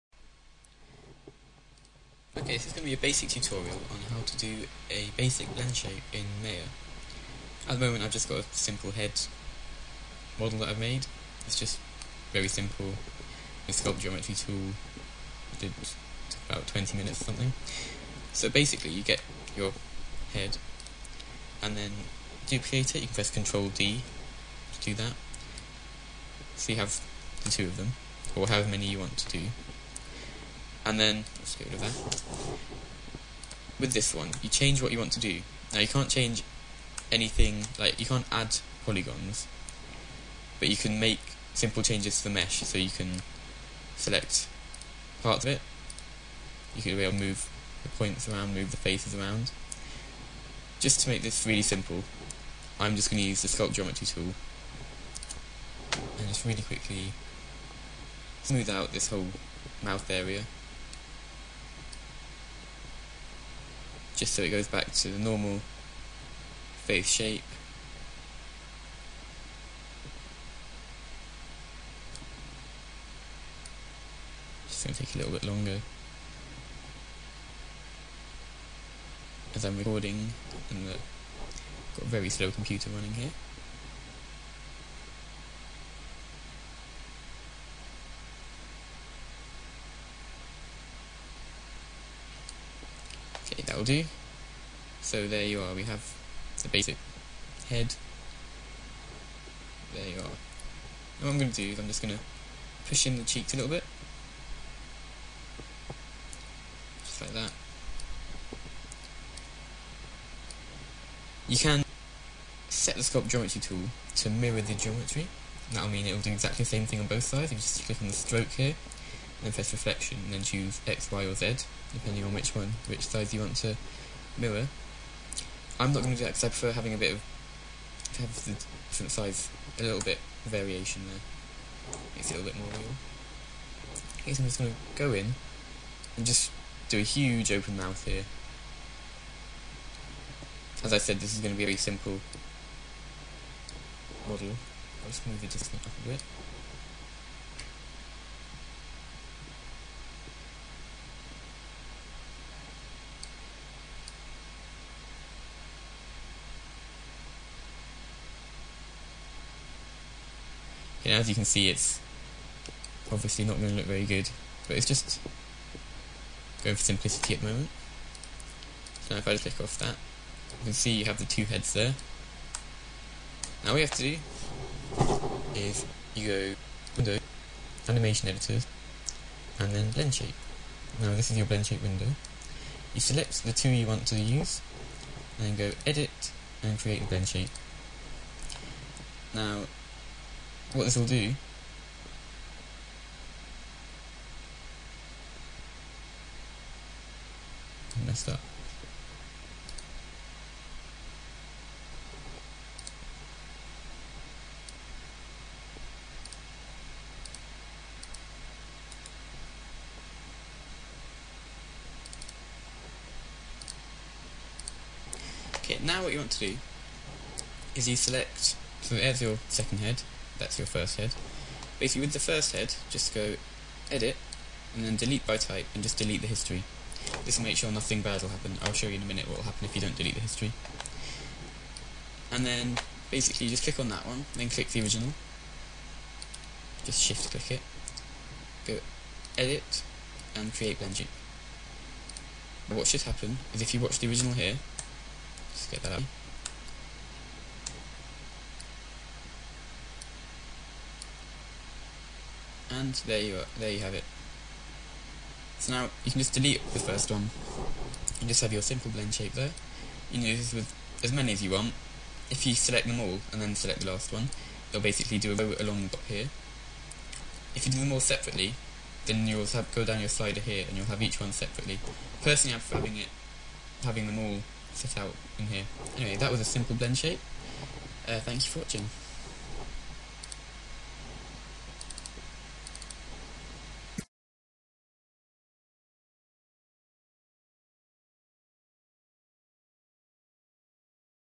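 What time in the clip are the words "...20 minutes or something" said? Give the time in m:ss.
0:16.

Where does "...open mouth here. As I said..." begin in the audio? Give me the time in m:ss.
2:17.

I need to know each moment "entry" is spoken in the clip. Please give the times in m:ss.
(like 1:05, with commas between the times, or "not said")
not said.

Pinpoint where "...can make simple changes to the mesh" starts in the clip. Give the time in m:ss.
0:40.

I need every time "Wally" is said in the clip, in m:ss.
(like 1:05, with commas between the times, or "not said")
not said.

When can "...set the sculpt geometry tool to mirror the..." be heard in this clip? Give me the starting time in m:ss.
1:52.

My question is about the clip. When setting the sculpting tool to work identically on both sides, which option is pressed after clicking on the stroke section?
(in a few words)
reflection.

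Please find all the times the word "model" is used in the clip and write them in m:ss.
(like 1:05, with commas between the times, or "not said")
0:10, 2:24.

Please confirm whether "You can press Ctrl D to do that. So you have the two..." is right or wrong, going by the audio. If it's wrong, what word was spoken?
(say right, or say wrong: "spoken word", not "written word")
right.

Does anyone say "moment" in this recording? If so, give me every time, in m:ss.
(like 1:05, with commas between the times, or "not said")
0:07, 2:47.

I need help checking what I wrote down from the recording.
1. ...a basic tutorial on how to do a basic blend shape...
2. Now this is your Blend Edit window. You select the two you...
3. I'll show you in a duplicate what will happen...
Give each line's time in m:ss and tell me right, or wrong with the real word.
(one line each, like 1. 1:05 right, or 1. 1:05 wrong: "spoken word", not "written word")
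1. 0:02 right
2. 3:01 wrong: "Shape", not "Edit"
3. 3:48 wrong: "minute", not "duplicate".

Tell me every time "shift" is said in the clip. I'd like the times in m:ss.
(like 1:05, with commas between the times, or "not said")
3:57.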